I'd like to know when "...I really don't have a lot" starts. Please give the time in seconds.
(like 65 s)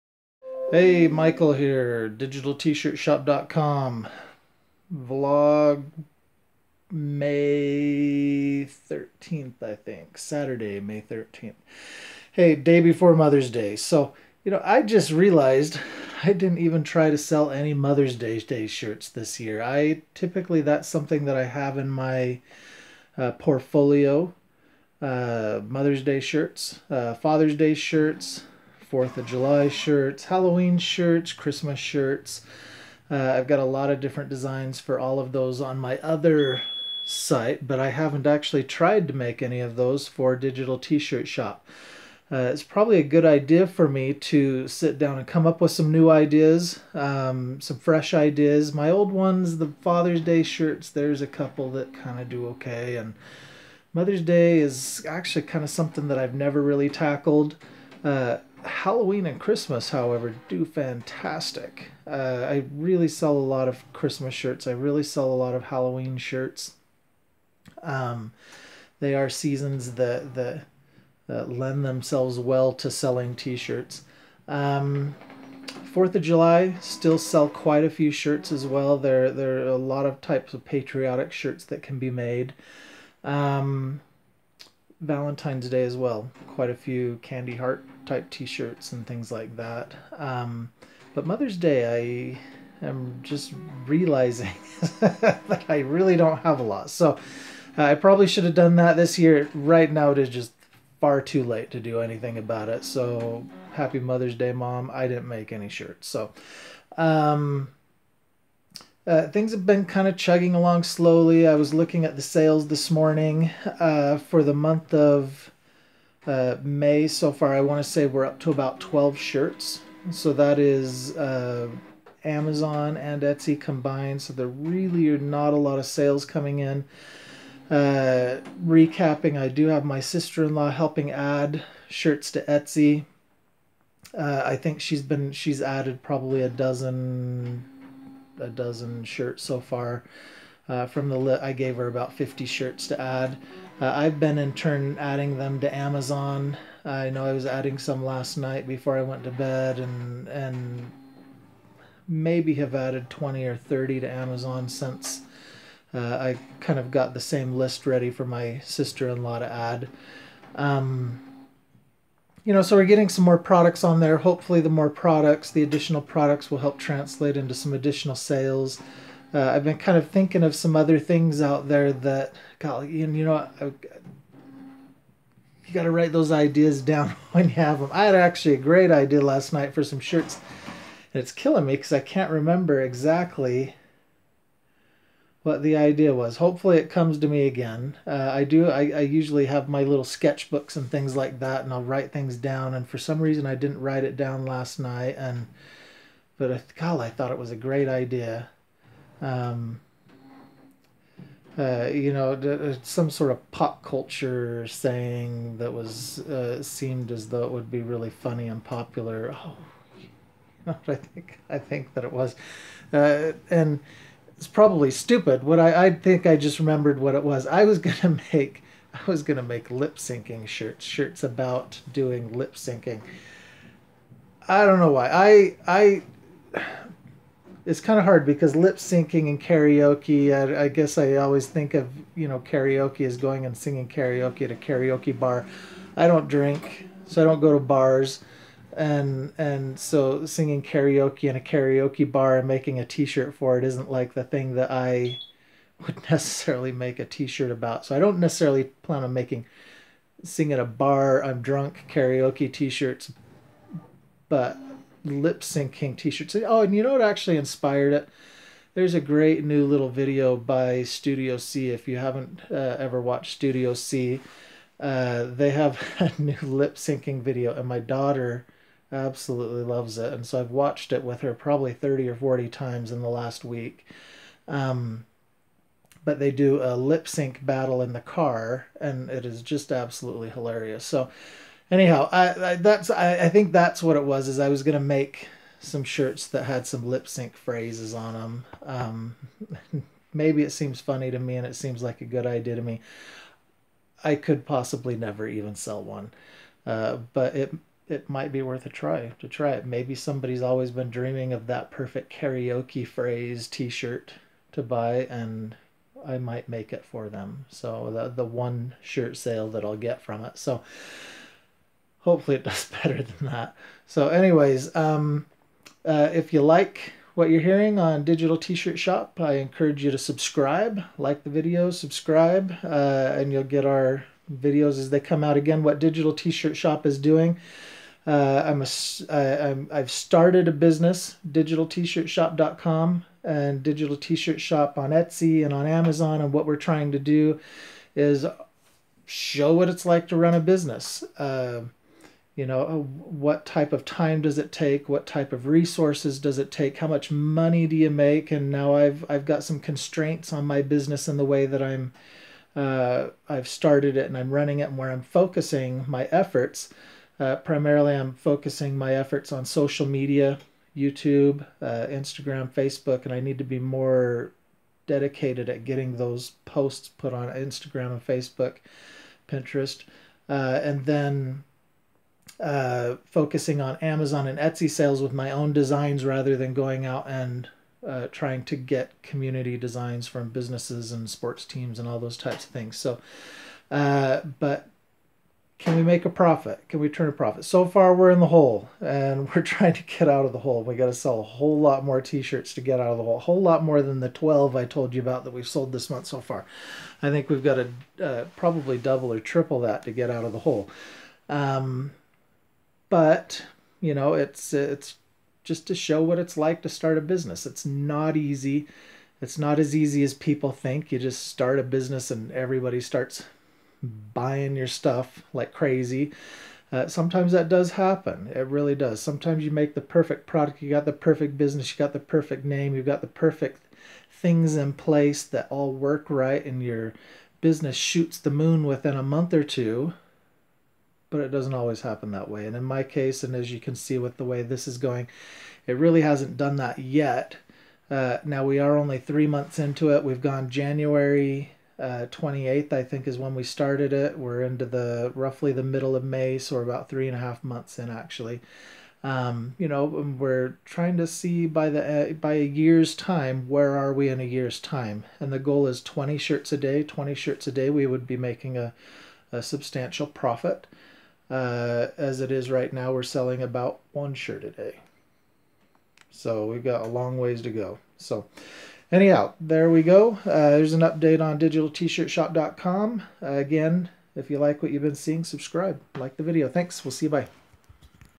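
95 s.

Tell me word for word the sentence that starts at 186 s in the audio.
Hopefully, it comes to me again.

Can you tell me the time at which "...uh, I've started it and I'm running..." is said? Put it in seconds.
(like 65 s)
352 s.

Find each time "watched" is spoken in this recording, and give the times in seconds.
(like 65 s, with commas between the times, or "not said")
263 s, 270 s.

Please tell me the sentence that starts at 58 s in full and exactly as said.
Uh, Halloween and Christmas, however, do fantastic.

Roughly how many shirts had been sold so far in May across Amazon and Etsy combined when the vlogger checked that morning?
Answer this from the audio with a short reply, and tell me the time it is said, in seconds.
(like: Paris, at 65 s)
12, at 118 s.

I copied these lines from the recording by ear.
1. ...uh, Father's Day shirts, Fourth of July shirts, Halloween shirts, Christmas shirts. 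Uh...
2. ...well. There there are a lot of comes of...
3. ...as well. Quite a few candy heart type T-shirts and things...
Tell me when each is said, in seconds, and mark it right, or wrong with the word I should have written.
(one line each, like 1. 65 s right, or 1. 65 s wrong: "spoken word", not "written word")
1. 26 s right
2. 78 s wrong: "types", not "comes"
3. 85 s right.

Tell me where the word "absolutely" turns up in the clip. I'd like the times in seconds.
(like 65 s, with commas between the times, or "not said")
268 s, 279 s.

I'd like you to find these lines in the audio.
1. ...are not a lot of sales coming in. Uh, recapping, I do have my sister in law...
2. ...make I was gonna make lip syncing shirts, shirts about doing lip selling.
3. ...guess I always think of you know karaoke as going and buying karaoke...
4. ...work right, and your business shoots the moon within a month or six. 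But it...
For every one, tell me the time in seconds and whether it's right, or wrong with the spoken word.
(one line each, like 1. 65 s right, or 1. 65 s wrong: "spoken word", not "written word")
1. 125 s right
2. 218 s wrong: "syncing", not "selling"
3. 230 s wrong: "singing", not "buying"
4. 425 s wrong: "two", not "six".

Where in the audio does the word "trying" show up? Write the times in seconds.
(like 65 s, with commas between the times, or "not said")
336 s, 378 s, 389 s, 450 s.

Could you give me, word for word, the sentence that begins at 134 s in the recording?
Uh, I think she's been she's added probably a dozen a dozen shirts so far.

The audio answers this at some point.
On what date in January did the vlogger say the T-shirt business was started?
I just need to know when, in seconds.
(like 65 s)
440 s.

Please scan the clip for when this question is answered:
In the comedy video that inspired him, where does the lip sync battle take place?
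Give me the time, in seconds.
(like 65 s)
277 s.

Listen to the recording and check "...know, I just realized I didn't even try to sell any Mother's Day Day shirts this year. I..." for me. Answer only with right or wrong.
right.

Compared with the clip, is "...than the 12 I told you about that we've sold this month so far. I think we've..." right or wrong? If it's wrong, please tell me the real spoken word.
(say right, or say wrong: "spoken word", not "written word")
right.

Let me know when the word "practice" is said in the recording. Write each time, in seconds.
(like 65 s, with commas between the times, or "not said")
not said.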